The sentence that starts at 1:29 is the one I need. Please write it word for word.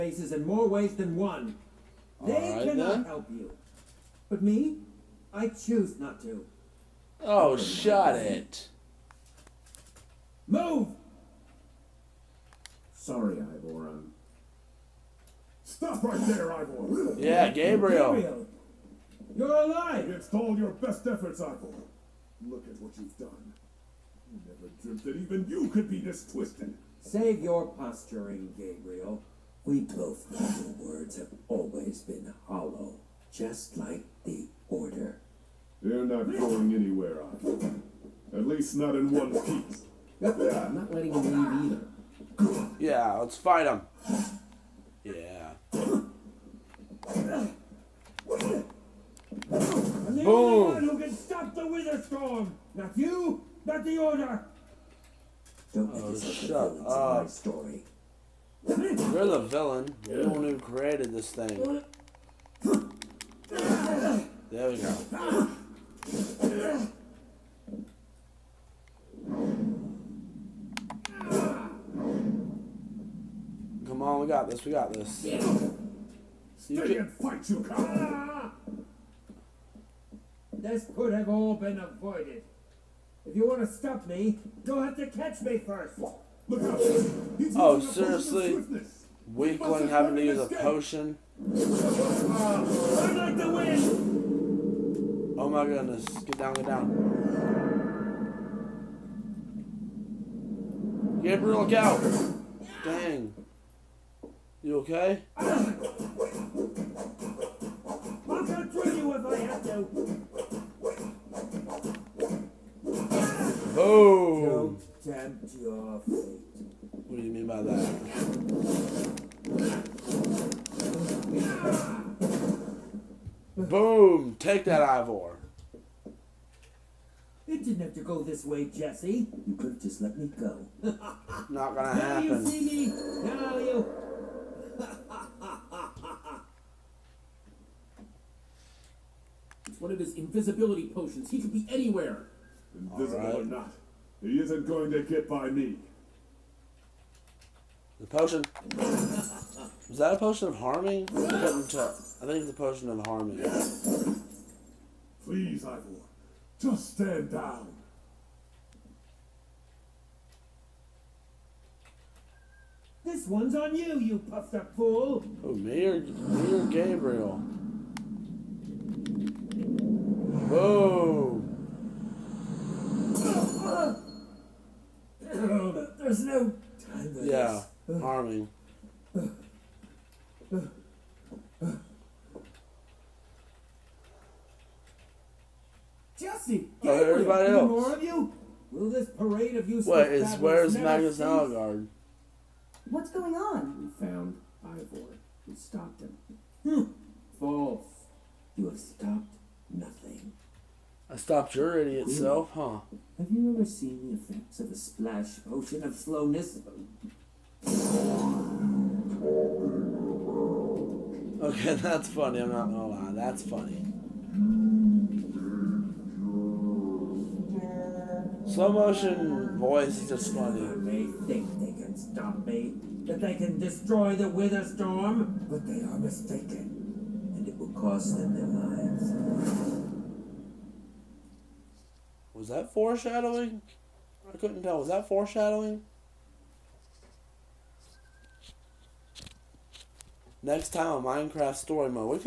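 Weakling having to use a potion?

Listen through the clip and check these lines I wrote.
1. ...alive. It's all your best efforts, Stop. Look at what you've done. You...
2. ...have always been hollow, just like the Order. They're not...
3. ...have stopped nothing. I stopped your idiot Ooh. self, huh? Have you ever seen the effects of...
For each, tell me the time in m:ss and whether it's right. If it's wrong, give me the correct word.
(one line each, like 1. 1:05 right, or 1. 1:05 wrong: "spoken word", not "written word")
1. 0:19 wrong: "Ivor", not "Stop"
2. 0:31 right
3. 3:18 right.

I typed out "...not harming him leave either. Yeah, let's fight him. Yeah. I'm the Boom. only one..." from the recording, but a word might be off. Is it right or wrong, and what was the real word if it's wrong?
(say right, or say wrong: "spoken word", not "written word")
wrong: "letting", not "harming".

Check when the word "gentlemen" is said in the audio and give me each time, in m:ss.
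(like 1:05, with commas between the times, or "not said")
not said.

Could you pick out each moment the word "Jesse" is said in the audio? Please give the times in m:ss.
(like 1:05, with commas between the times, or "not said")
2:08, 3:06.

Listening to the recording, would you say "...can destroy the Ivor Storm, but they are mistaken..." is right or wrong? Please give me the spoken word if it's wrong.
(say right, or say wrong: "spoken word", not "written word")
wrong: "Wither", not "Ivor".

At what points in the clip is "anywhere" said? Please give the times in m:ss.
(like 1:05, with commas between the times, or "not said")
0:36, 2:21.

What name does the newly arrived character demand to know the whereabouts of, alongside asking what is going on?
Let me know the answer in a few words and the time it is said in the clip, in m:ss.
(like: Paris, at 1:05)
Magnus, at 3:10.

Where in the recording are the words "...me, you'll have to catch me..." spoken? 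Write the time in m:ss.
1:24.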